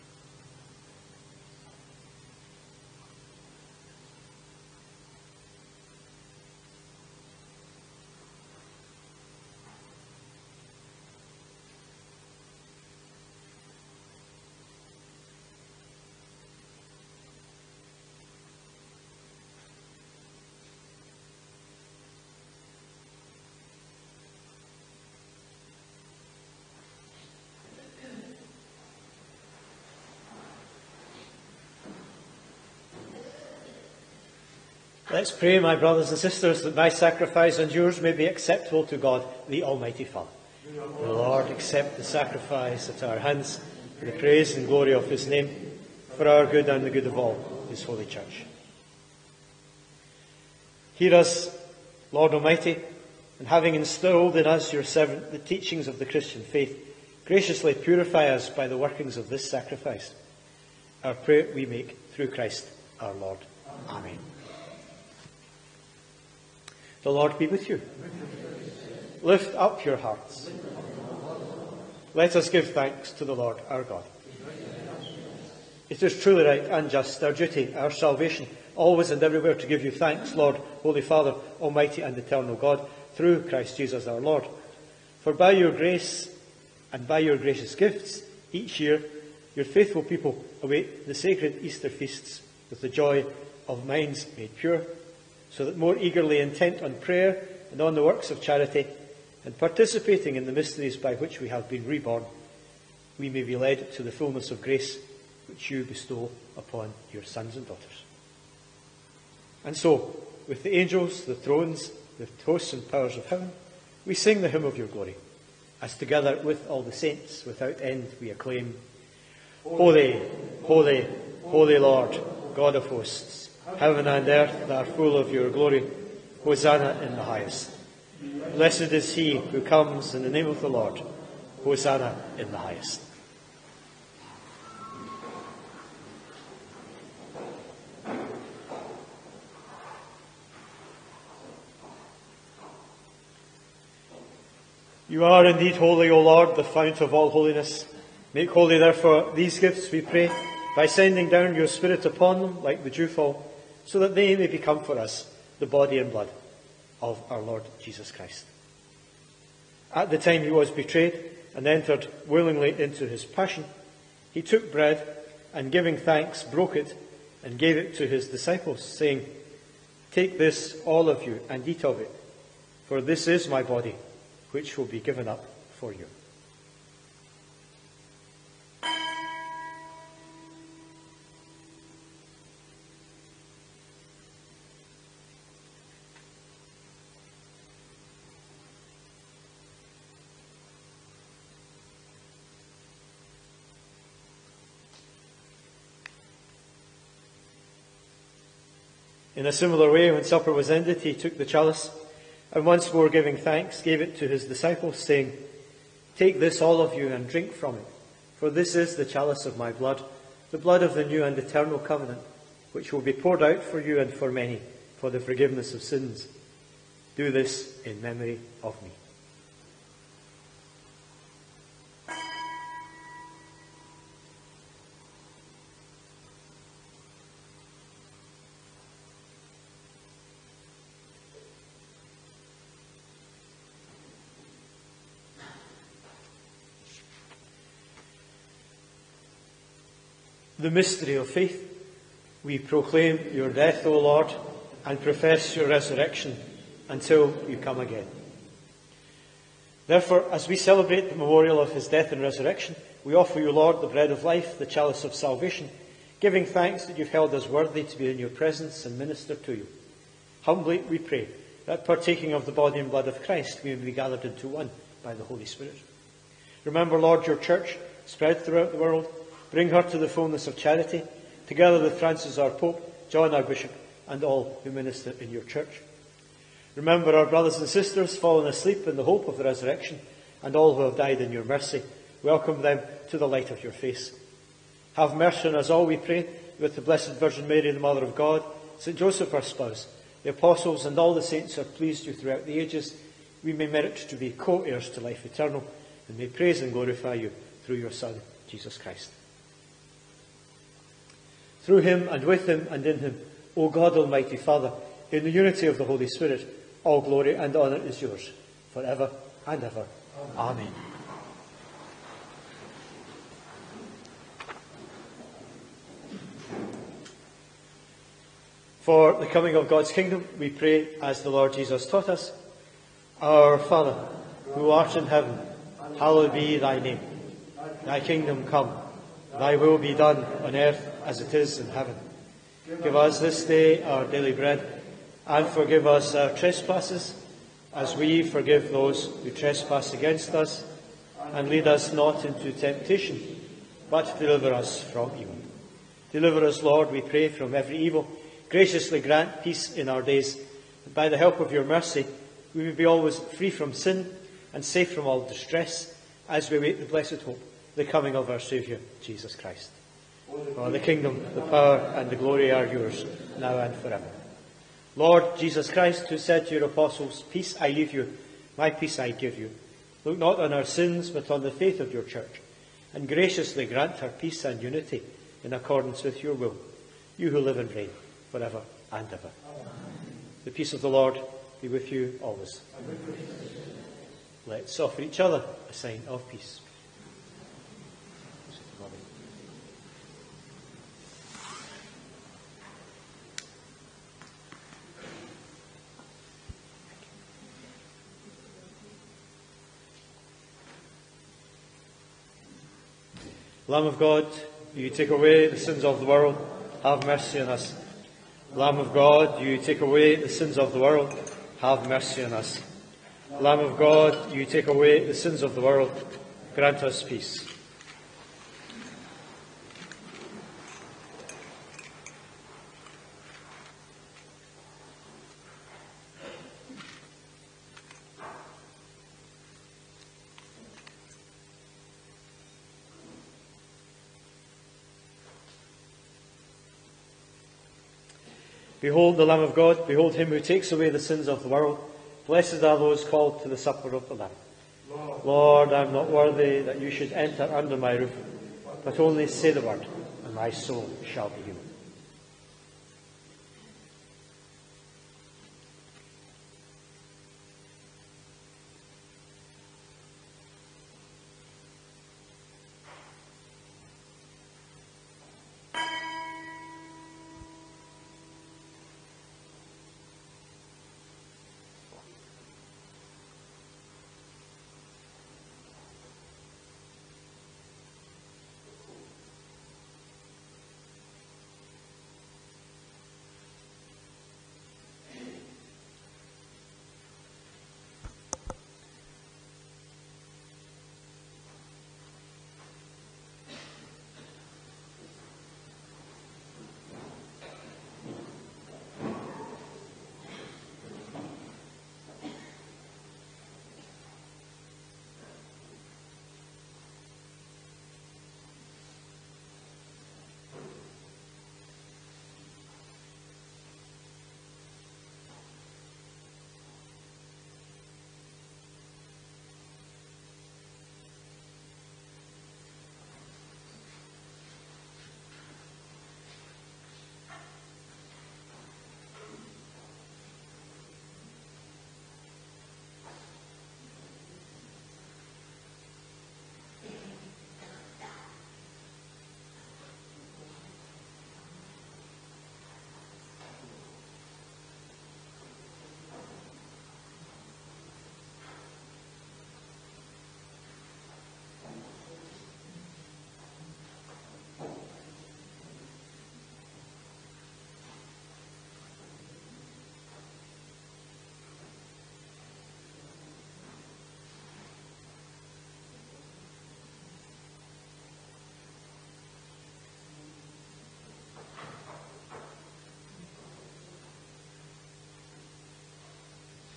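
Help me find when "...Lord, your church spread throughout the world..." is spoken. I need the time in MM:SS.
04:26.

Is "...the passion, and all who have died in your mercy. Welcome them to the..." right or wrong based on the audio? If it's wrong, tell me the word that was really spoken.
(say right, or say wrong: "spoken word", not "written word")
wrong: "resurrection", not "passion".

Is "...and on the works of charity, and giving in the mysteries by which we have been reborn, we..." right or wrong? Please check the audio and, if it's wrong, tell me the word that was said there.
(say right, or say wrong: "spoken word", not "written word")
wrong: "participating", not "giving".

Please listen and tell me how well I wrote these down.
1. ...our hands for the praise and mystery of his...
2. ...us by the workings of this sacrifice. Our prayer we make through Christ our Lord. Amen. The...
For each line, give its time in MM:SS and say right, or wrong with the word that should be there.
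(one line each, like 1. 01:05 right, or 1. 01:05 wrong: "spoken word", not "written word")
1. 00:43 wrong: "glory", not "mystery"
2. 00:58 right.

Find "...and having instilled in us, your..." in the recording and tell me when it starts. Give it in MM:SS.
00:53.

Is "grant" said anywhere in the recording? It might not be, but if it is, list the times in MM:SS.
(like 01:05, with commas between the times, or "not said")
05:48, 06:13, 06:56.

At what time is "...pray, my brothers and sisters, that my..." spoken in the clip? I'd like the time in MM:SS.
00:35.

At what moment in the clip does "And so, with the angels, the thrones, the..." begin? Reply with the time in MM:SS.
01:49.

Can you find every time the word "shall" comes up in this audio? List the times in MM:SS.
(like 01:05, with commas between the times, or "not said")
07:31.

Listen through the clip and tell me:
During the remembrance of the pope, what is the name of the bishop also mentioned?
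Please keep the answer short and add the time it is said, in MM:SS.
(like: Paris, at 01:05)
John, at 04:33.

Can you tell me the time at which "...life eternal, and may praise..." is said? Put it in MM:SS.
04:54.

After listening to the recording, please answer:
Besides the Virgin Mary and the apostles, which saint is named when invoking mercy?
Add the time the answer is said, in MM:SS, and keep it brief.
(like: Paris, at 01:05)
St. Joseph, at 04:48.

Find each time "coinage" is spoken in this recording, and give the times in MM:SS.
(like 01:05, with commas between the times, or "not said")
not said.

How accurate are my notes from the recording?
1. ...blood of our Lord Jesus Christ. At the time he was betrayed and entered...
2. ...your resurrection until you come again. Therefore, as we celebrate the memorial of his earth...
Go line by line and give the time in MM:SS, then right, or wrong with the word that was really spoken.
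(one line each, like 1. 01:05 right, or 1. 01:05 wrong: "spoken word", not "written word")
1. 02:36 right
2. 04:05 wrong: "death", not "earth".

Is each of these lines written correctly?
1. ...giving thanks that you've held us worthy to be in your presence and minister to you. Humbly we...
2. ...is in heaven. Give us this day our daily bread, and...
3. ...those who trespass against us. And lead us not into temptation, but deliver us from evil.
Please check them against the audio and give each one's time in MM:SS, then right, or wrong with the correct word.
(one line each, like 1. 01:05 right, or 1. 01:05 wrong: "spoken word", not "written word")
1. 04:16 right
2. 05:31 right
3. 05:38 right.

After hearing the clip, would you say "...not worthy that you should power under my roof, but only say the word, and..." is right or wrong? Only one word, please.
wrong.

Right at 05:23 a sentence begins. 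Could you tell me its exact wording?
Our Father, who art in heaven, hallowed be thy name.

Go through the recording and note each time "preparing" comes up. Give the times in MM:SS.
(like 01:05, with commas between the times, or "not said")
not said.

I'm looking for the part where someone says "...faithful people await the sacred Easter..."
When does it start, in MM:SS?
01:29.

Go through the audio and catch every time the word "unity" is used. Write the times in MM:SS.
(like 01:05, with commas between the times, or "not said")
05:05, 06:14.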